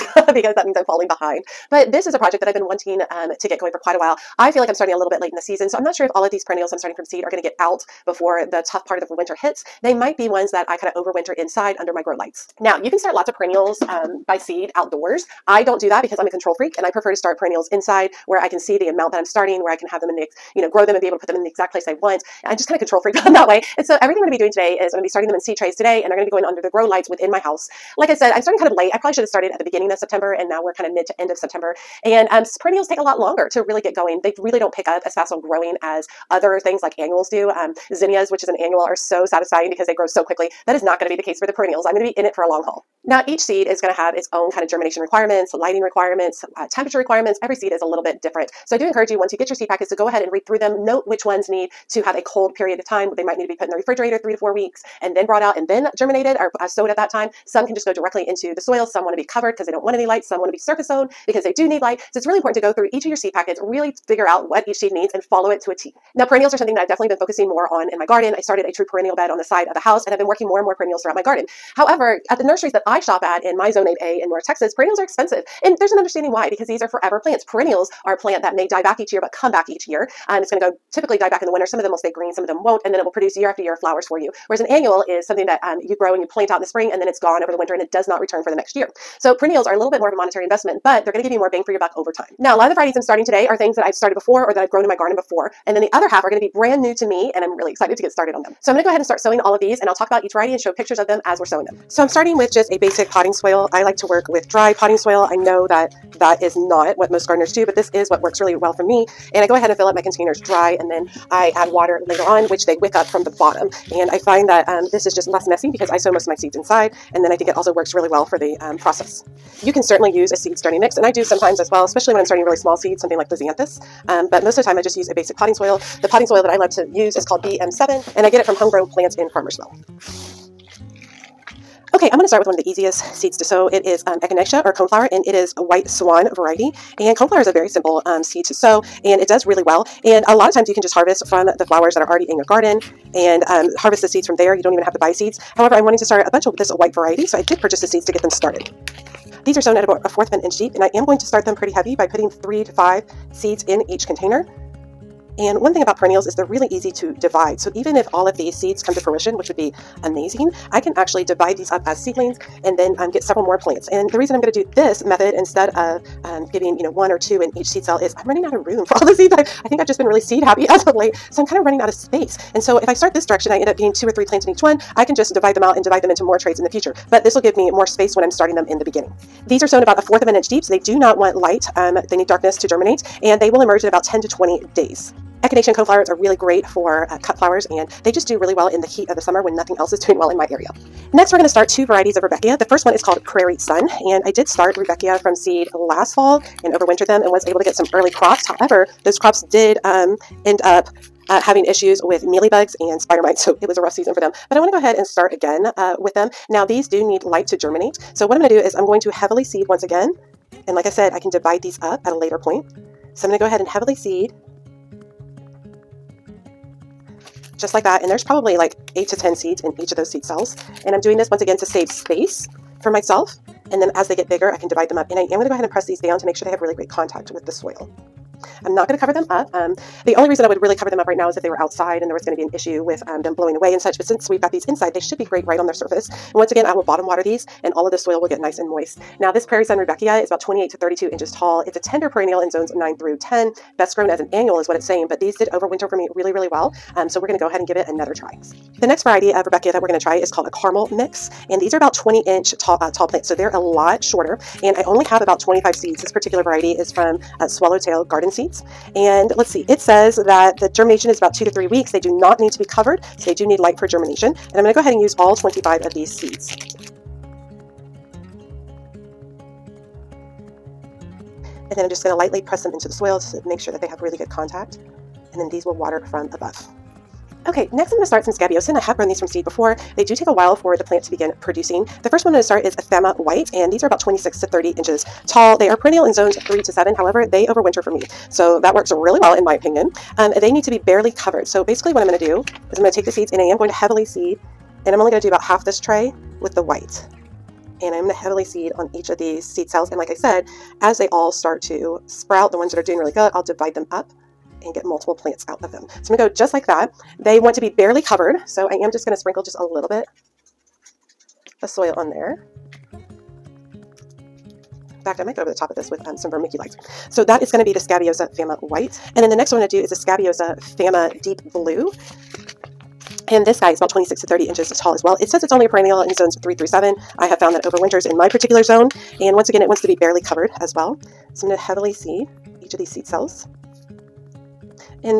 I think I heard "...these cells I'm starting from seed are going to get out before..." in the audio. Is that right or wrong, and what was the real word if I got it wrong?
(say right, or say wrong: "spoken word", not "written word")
wrong: "perennials", not "cells".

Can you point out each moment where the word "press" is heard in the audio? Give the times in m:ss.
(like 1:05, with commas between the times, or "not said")
3:45, 4:32.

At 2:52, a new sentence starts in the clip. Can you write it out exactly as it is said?
And so if I start this direction, I end up getting two or three plants in each one.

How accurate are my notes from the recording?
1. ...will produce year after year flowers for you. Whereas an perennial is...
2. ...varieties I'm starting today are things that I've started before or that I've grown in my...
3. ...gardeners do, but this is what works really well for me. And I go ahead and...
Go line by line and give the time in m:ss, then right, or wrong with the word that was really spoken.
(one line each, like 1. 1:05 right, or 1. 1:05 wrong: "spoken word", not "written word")
1. 1:23 wrong: "annual", not "perennial"
2. 1:32 right
3. 1:47 right.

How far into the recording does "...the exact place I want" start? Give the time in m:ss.
0:21.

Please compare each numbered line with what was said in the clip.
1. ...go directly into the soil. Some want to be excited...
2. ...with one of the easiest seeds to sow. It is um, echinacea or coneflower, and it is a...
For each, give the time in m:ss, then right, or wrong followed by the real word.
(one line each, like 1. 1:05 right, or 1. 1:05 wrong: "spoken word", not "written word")
1. 0:57 wrong: "covered", not "excited"
2. 2:12 right.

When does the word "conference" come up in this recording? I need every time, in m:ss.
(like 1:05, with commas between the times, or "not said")
not said.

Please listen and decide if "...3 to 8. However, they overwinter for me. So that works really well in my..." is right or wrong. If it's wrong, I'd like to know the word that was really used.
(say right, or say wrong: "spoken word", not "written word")
wrong: "7", not "8".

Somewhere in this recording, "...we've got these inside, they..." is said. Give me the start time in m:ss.
3:54.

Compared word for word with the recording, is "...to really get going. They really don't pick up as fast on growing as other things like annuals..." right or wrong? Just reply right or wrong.
right.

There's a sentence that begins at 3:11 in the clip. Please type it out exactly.
Next, we're going to start two varieties of Rudbeckia.